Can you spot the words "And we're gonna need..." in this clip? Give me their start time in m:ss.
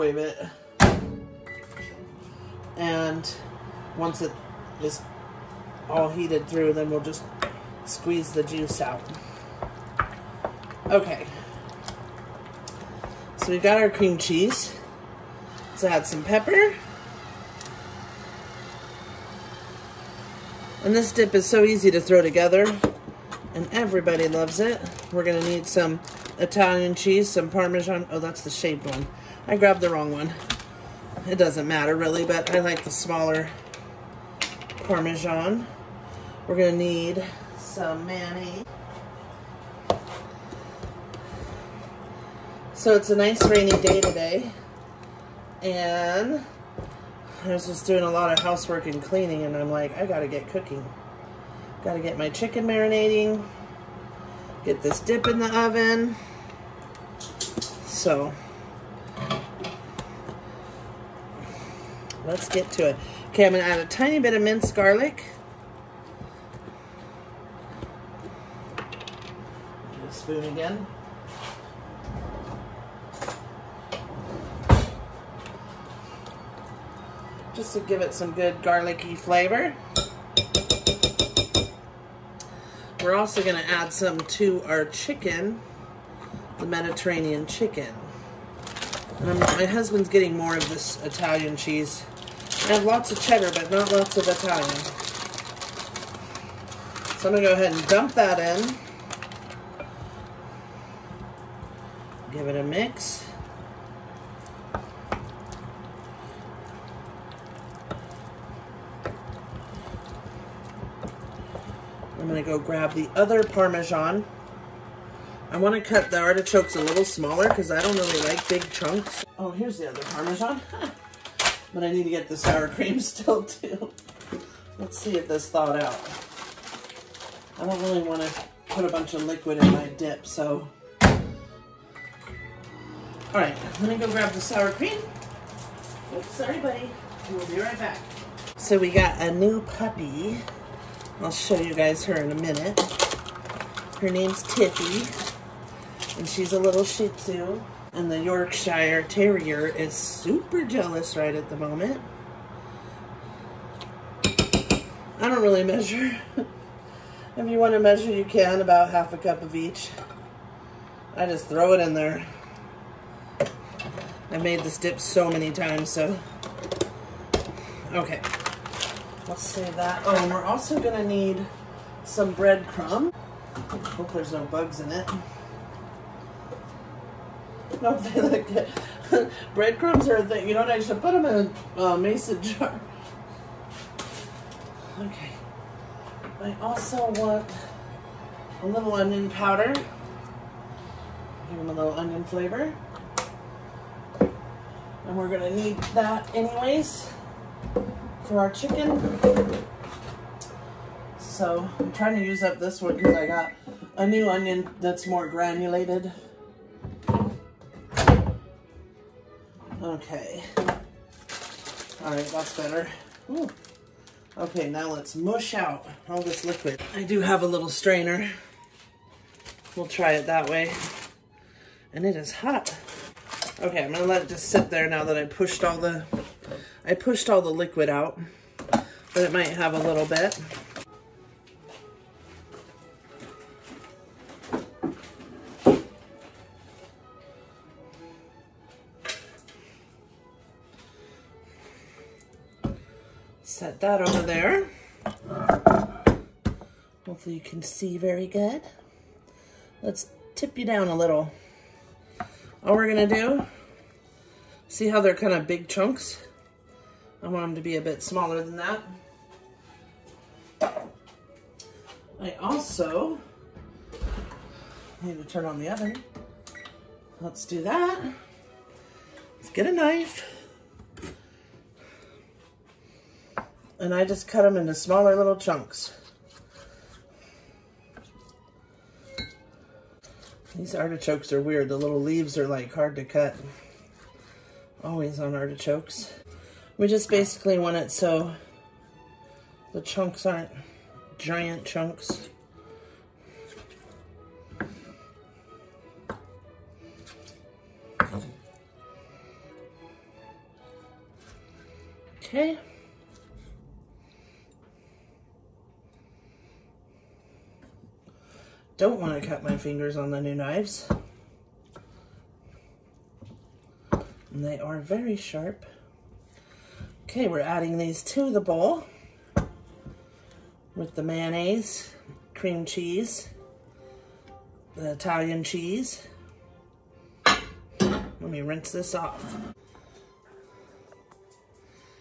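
3:14.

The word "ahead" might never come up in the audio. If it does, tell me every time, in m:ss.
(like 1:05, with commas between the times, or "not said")
1:37.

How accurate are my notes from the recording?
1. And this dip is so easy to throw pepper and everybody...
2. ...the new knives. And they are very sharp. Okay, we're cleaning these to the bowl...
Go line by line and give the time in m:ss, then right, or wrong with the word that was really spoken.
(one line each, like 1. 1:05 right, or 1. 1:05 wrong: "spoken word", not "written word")
1. 0:20 wrong: "together", not "pepper"
2. 5:10 wrong: "adding", not "cleaning".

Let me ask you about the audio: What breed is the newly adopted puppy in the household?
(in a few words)
Shih Tzu.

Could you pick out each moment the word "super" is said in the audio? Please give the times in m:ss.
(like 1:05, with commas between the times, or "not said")
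2:29.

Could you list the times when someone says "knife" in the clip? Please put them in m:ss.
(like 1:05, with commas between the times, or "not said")
4:29.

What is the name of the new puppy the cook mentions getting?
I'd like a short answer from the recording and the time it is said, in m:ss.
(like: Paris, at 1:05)
Tippy, at 2:24.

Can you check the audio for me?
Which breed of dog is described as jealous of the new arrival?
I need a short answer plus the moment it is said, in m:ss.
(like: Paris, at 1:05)
Yorkshire Terrier, at 2:28.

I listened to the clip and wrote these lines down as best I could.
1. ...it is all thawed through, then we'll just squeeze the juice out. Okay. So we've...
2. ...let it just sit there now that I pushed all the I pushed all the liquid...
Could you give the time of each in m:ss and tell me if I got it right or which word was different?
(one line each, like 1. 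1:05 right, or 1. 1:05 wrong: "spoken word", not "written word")
1. 0:04 wrong: "heated", not "thawed"
2. 3:44 right.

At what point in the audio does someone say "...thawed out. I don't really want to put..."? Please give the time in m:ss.
2:05.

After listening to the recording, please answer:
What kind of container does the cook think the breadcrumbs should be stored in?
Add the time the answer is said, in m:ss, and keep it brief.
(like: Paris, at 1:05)
mason jar, at 3:01.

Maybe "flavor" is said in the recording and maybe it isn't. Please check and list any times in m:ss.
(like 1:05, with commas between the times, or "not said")
1:19, 3:12.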